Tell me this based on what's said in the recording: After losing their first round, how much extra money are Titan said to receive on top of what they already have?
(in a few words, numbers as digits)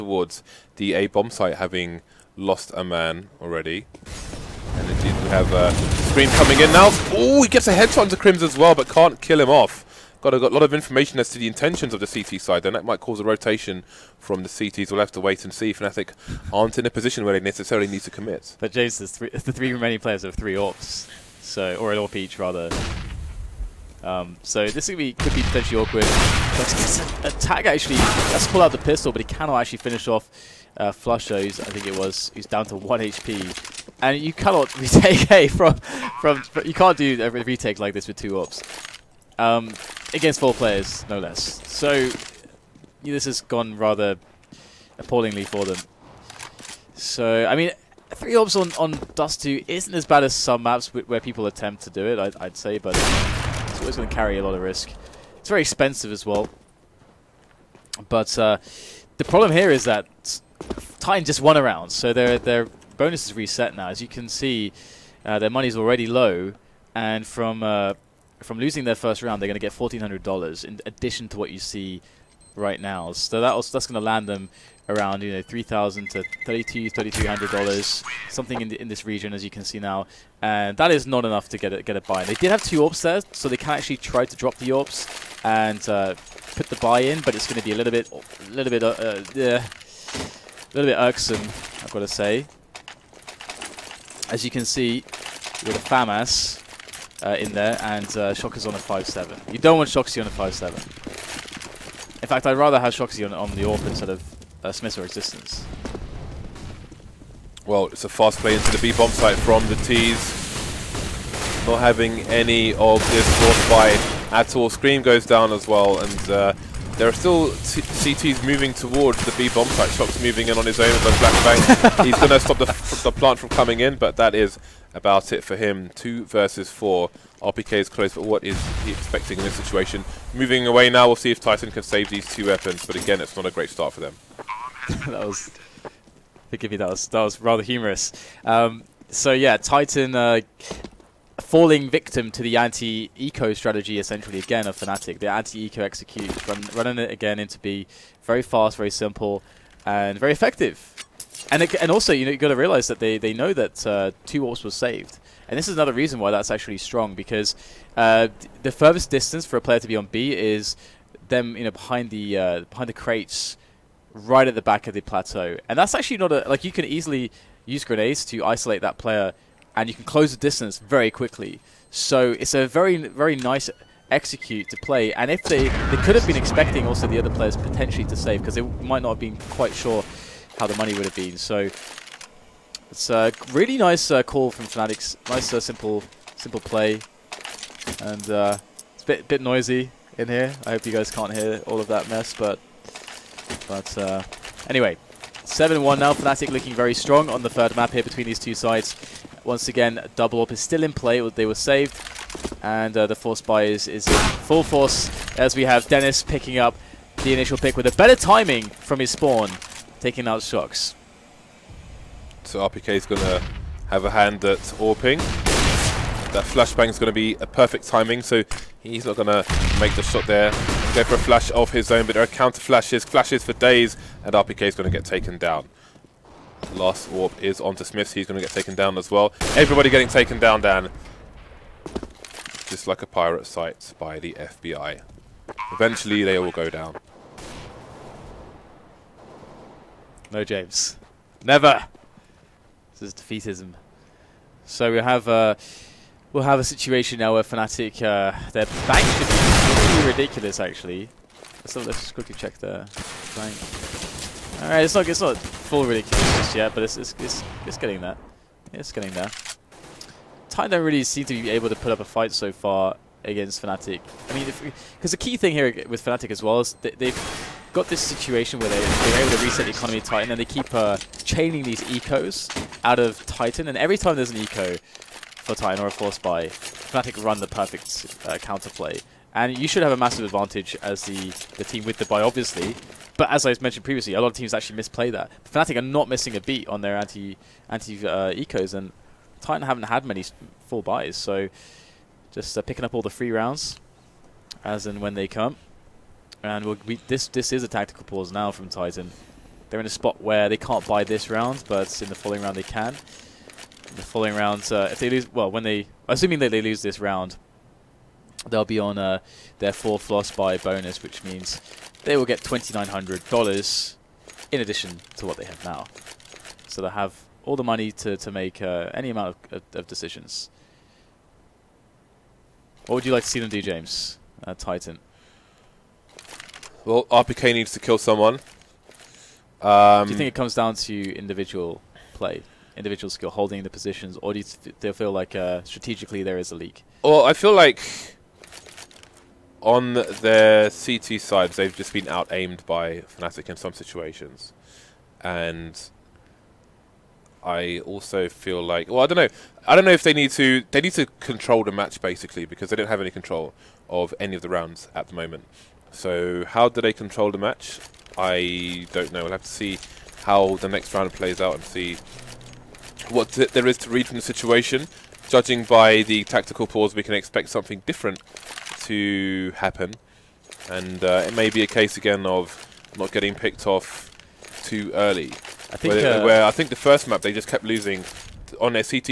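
$1,400.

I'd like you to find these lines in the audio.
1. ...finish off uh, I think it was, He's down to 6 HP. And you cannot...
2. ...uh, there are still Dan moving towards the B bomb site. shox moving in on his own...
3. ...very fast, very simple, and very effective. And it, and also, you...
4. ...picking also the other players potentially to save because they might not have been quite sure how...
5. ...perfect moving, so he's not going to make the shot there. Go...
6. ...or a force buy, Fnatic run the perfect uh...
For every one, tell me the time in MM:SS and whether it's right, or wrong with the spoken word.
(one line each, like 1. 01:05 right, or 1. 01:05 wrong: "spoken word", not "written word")
1. 00:29 wrong: "1", not "6"
2. 01:56 wrong: "CTs", not "Dan"
3. 02:28 right
4. 02:56 wrong: "expecting", not "picking"
5. 03:37 wrong: "timing", not "moving"
6. 04:35 right.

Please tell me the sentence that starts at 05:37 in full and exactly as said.
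Well, I feel like on their CT sides, they've just been out aimed by Fnatic in some situations.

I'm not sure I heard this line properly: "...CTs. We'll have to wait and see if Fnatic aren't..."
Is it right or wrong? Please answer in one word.
right.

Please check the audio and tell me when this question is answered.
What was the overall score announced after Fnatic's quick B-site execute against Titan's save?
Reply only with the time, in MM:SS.
03:15.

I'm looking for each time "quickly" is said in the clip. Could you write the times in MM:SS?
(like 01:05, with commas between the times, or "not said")
02:51, 04:12.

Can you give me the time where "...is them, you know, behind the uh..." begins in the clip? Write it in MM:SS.
02:40.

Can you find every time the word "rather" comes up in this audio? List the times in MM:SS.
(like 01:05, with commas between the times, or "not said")
00:22, 00:43, 01:42, 02:17.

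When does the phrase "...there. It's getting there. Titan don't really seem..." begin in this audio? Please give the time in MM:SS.
04:17.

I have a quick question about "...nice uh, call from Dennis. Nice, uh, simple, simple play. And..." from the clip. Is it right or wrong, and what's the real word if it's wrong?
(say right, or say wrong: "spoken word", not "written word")
wrong: "Fnatics", not "Dennis".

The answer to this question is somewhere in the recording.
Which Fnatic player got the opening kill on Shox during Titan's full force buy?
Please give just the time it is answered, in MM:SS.
03:25.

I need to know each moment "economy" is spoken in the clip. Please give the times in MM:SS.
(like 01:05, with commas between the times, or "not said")
04:29.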